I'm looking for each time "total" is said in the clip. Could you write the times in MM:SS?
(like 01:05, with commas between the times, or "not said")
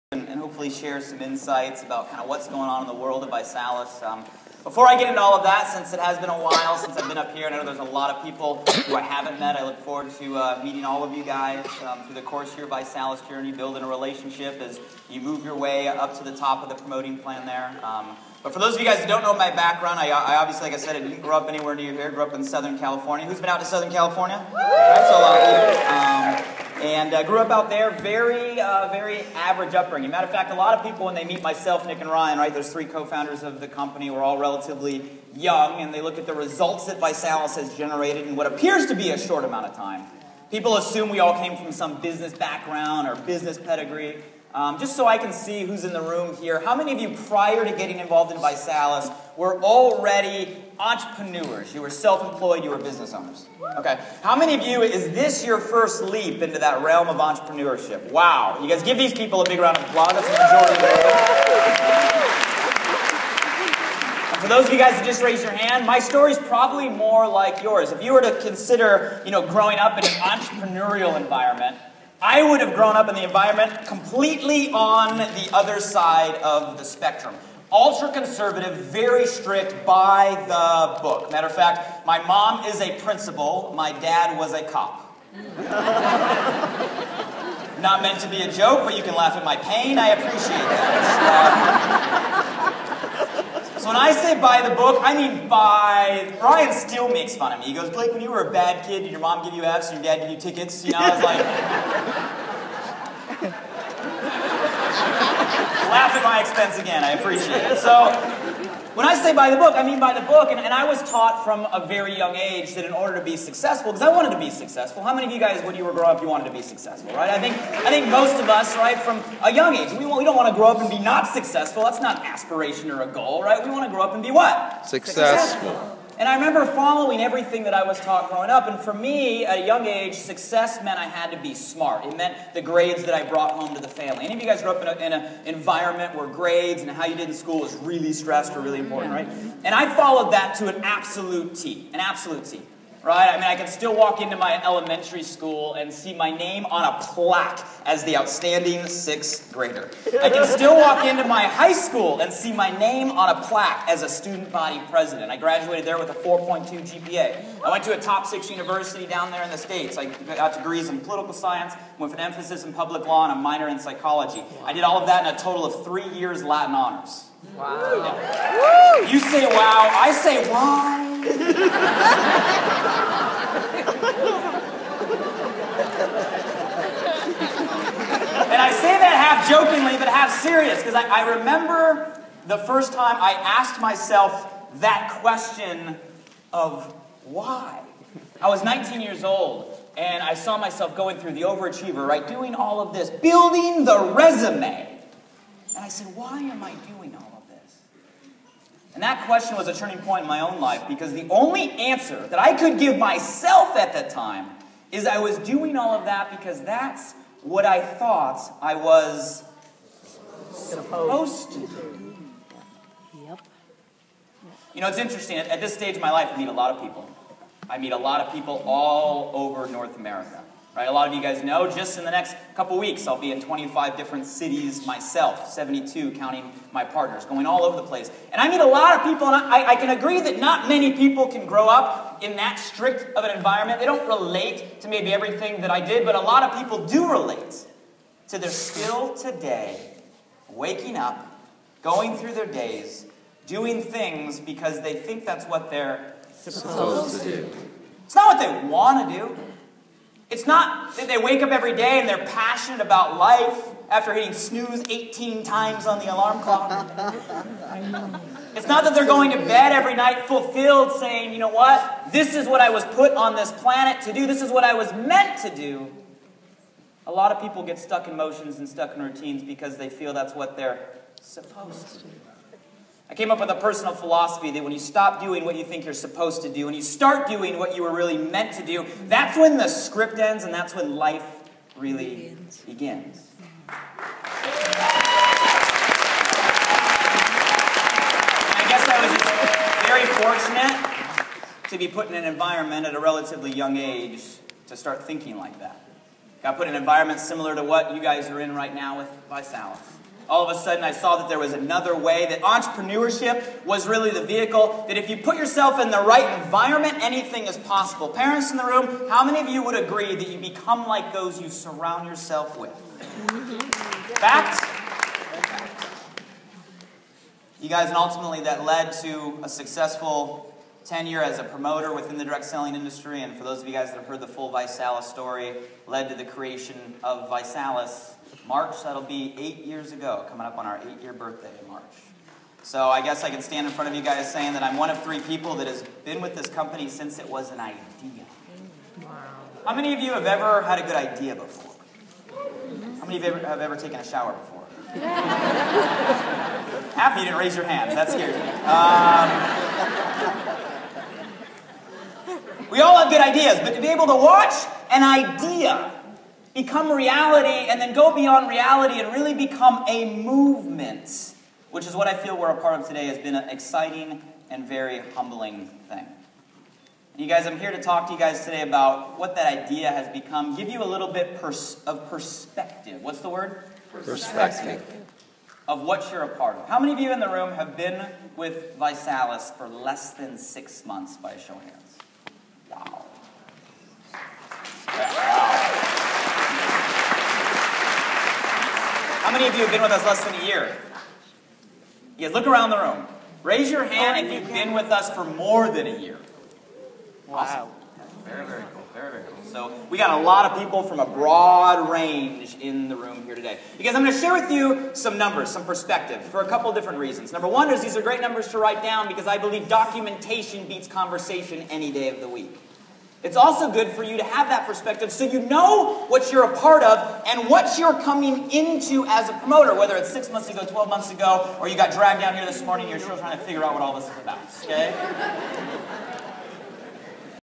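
02:45.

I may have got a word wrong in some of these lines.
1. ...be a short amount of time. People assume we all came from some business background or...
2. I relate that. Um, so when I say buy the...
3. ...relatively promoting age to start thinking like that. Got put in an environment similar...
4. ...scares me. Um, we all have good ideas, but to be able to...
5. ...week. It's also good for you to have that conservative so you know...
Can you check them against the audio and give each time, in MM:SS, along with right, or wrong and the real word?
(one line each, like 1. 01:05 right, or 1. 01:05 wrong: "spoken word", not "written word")
1. 00:38 right
2. 01:29 wrong: "appreciate", not "relate"
3. 04:52 wrong: "young", not "promoting"
4. 05:48 right
5. 06:52 wrong: "perspective", not "conservative".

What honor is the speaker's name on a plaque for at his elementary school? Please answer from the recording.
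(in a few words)
Outstanding sixth grader.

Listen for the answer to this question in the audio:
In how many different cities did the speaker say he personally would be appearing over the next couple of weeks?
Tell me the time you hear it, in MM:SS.
03:43.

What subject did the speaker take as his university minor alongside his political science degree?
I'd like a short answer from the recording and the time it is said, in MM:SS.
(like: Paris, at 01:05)
Psychology, at 02:43.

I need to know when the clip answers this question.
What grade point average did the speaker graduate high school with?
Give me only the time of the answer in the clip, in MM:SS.
02:36.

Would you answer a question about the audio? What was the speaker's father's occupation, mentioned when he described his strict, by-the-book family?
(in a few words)
Cop.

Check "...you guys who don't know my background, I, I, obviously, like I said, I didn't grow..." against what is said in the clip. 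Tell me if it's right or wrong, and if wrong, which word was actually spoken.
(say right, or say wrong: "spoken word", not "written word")
right.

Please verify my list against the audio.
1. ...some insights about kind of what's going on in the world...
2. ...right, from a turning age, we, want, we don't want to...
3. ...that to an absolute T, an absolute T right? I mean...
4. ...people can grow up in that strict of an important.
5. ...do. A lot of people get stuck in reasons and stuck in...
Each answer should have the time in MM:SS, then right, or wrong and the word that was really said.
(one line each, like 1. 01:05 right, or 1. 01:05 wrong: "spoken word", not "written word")
1. 00:01 right
2. 01:58 wrong: "young", not "turning"
3. 02:20 right
4. 03:50 wrong: "environment", not "important"
5. 04:25 wrong: "motions", not "reasons".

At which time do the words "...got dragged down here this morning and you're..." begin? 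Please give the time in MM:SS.
07:01.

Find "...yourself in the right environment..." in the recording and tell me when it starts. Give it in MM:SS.
05:05.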